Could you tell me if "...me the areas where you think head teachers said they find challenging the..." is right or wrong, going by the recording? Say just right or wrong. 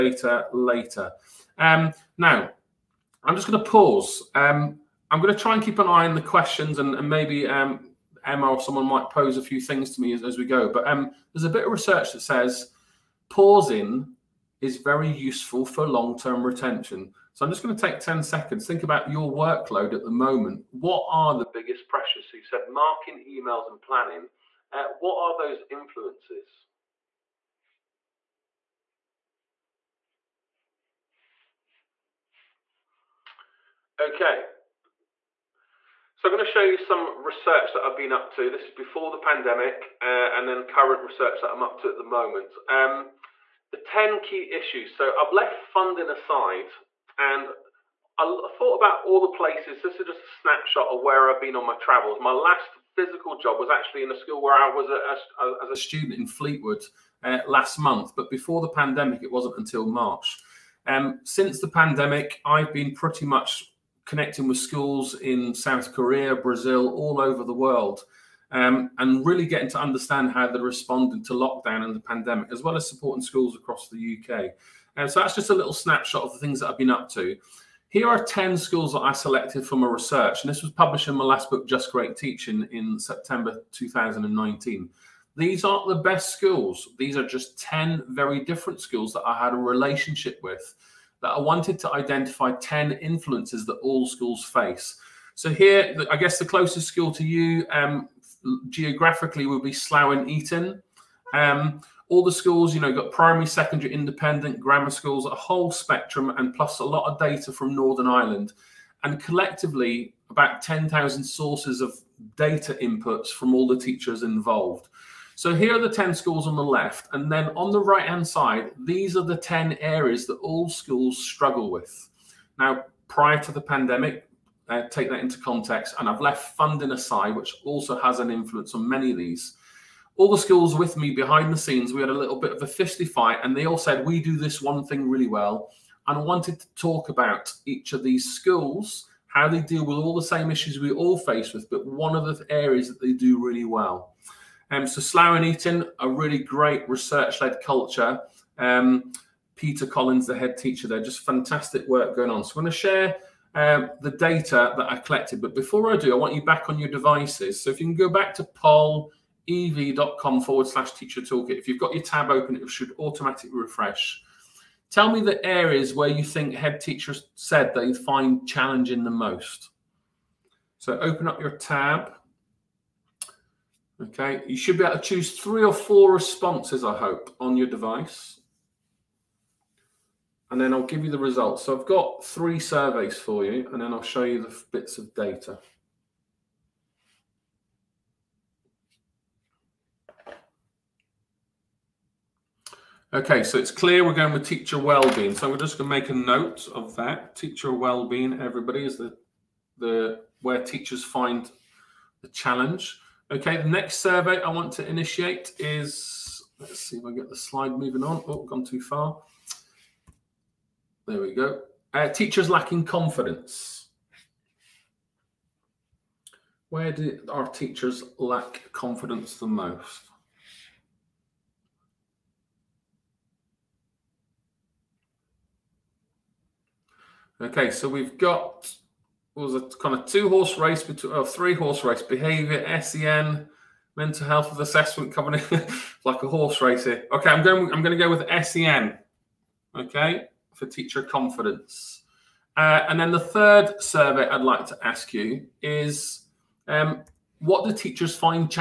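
right.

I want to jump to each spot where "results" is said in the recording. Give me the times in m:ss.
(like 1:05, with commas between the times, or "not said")
3:01.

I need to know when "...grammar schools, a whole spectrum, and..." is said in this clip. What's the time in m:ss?
1:44.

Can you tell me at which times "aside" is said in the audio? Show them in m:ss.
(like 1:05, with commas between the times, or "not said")
0:46, 2:06.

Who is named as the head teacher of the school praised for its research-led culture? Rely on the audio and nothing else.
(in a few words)
Peter Collins.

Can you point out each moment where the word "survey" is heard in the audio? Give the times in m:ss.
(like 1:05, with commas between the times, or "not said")
3:02, 3:23, 4:03.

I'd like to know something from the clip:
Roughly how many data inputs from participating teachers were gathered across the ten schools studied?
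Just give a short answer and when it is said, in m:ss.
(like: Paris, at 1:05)
10,000, at 1:50.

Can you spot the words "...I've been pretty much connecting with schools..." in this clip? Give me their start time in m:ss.
1:02.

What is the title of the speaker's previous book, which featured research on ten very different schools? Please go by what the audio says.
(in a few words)
Just Great Teaching.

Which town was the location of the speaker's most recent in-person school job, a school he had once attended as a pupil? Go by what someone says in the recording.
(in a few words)
Fleetwood.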